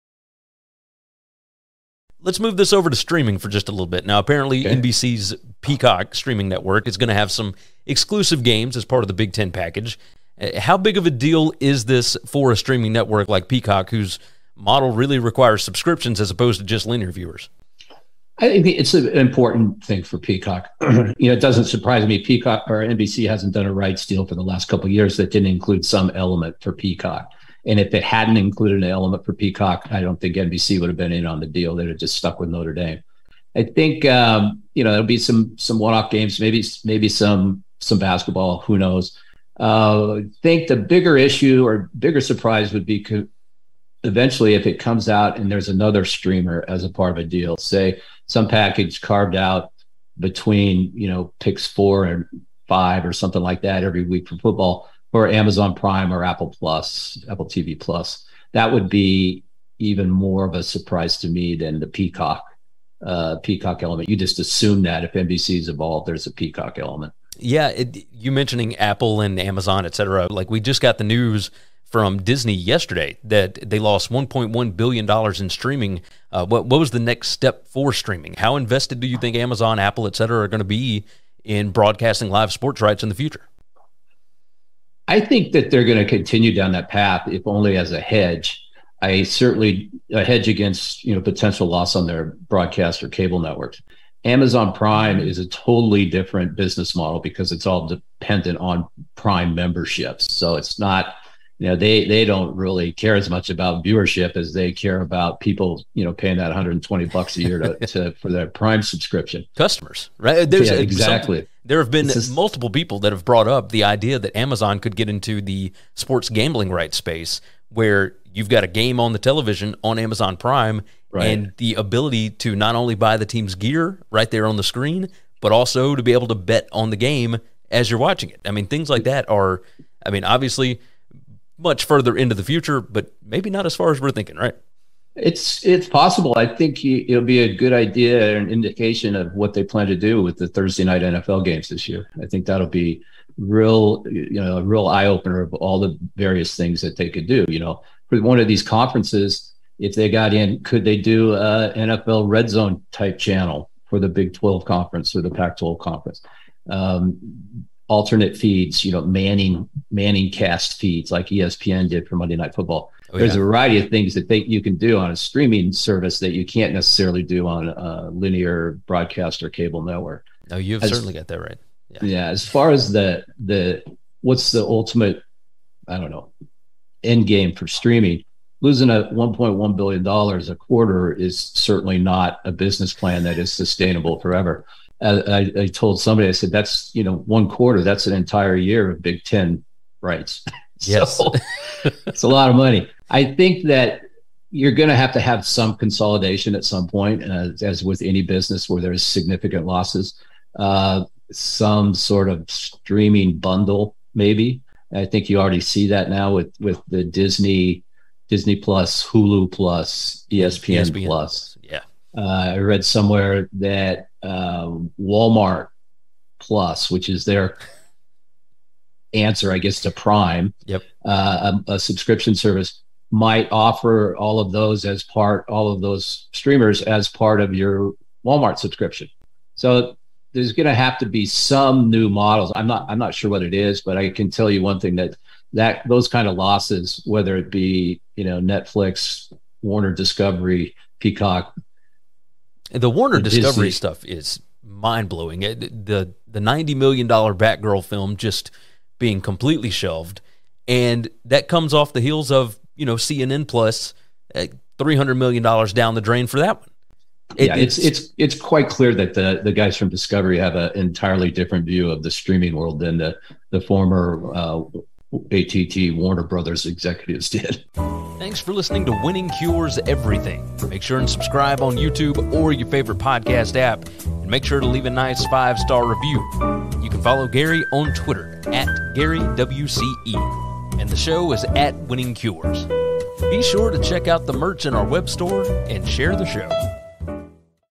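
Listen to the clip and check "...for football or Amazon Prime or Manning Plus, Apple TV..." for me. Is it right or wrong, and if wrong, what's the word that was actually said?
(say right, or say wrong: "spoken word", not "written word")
wrong: "Apple", not "Manning".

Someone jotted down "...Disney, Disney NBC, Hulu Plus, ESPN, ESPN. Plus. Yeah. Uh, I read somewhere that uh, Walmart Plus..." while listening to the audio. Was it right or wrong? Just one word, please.
wrong.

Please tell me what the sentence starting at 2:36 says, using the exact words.
Um, alternate feeds, you know, Manning Manning cast feeds like ESPN did for Monday Night Football.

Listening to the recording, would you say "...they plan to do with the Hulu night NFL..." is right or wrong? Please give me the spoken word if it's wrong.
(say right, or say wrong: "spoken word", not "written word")
wrong: "Thursday", not "Hulu".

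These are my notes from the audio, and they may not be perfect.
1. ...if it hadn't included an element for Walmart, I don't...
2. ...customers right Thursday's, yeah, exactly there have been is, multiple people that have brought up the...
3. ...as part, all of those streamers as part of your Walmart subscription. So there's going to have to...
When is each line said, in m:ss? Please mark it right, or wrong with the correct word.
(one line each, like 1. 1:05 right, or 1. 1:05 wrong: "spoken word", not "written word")
1. 0:27 wrong: "Peacock", not "Walmart"
2. 1:49 wrong: "There", not "Thursday"
3. 3:44 right.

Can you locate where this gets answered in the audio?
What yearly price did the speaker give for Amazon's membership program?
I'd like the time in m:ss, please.
1:46.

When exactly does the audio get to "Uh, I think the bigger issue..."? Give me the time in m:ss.
0:39.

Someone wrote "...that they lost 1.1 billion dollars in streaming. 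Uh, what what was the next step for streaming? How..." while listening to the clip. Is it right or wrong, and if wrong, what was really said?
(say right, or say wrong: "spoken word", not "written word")
right.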